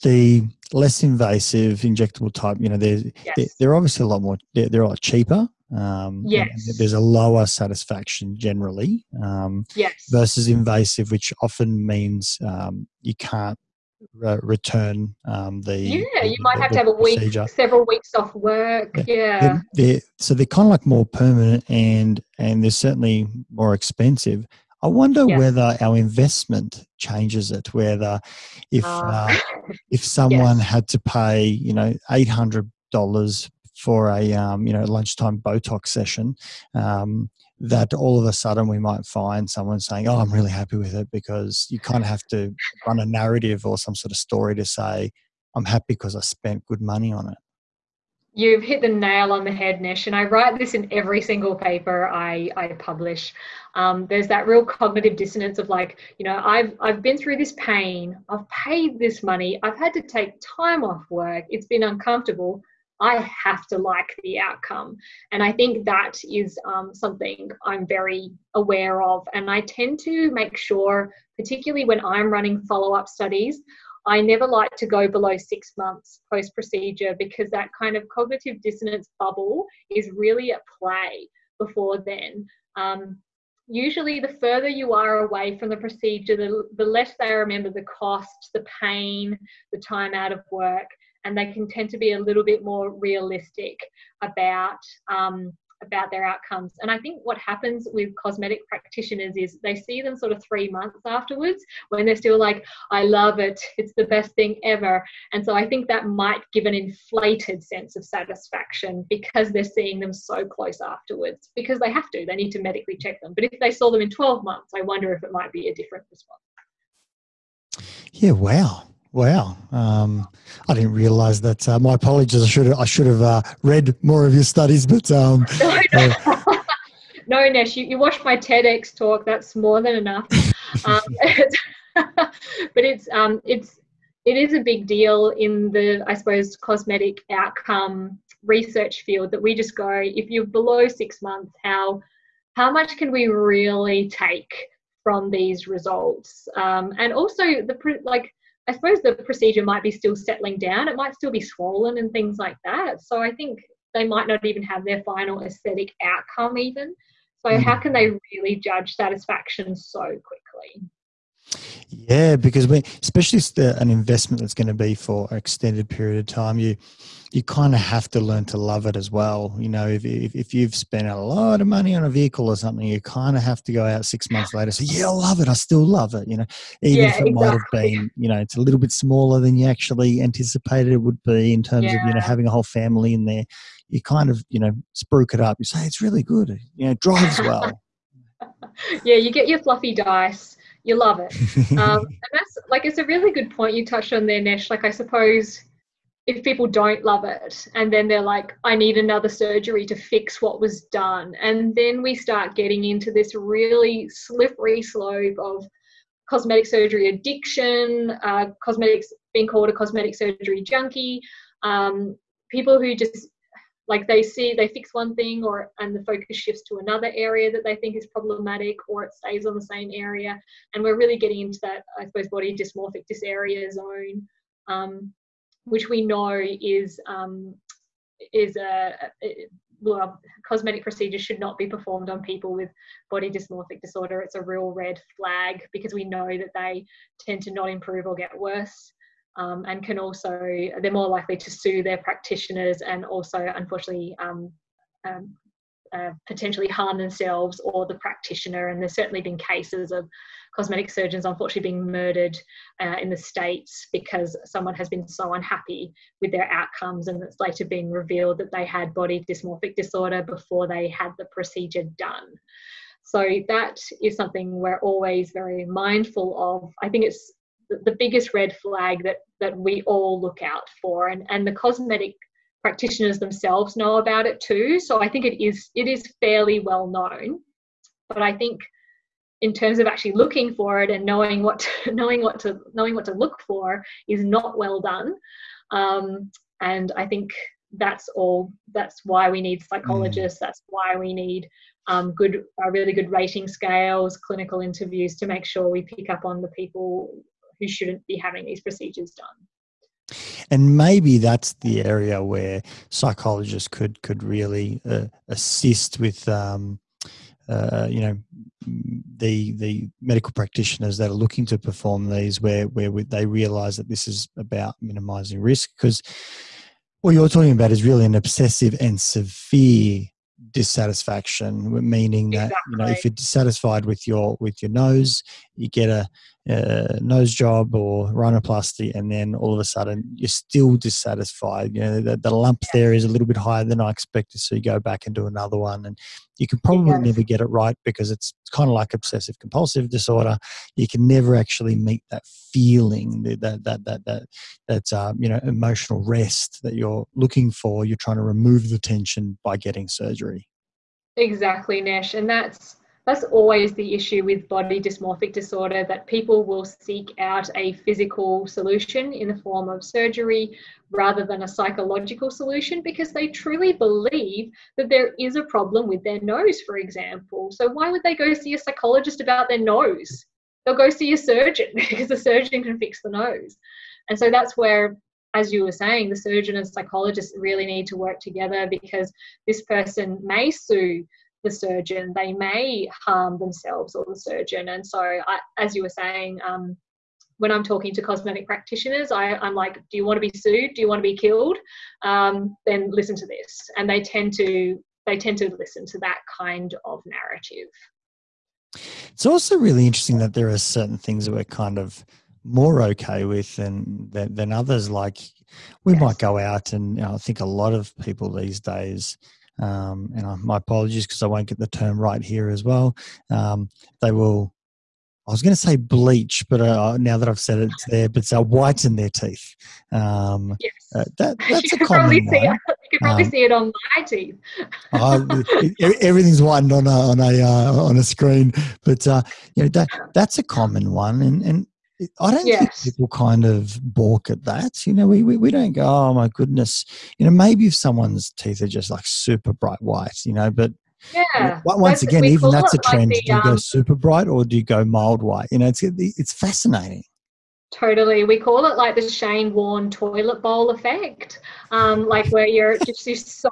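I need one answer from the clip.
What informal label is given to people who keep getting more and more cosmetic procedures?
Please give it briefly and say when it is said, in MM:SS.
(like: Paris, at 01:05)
cosmetic surgery junkie, at 03:29.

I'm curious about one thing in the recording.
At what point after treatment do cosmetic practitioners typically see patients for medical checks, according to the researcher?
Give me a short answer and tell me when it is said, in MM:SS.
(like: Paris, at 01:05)
3 months, at 01:40.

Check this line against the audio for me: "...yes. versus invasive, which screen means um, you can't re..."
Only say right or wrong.
wrong.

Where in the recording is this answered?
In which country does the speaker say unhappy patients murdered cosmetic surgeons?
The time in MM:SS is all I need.
04:13.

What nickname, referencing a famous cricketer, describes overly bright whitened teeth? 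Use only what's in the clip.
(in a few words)
Shane Warne toilet bowl effect.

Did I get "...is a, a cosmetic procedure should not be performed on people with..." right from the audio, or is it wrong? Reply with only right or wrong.
right.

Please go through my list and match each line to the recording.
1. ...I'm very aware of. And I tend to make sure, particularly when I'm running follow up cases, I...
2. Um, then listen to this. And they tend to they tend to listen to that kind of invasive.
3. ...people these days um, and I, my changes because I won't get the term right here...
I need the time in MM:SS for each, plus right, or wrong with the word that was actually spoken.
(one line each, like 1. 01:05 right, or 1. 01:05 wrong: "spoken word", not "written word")
1. 01:07 wrong: "studies", not "cases"
2. 06:32 wrong: "narrative", not "invasive"
3. 06:47 wrong: "apologies", not "changes".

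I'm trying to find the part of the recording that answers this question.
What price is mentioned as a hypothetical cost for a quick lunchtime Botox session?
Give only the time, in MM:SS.
00:32.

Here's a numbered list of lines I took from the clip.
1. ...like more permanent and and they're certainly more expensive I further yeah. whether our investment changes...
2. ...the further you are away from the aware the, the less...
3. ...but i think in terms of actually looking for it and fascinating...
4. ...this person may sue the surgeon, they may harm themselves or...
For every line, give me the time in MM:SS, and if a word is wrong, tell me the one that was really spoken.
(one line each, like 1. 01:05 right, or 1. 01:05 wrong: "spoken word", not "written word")
1. 00:20 wrong: "wonder", not "further"
2. 01:24 wrong: "procedure", not "aware"
3. 04:38 wrong: "knowing", not "fascinating"
4. 06:19 right.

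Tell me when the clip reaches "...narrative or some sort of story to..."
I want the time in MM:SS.
00:43.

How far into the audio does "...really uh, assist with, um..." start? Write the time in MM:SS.
05:04.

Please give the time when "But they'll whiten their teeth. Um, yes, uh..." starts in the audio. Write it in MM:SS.
06:58.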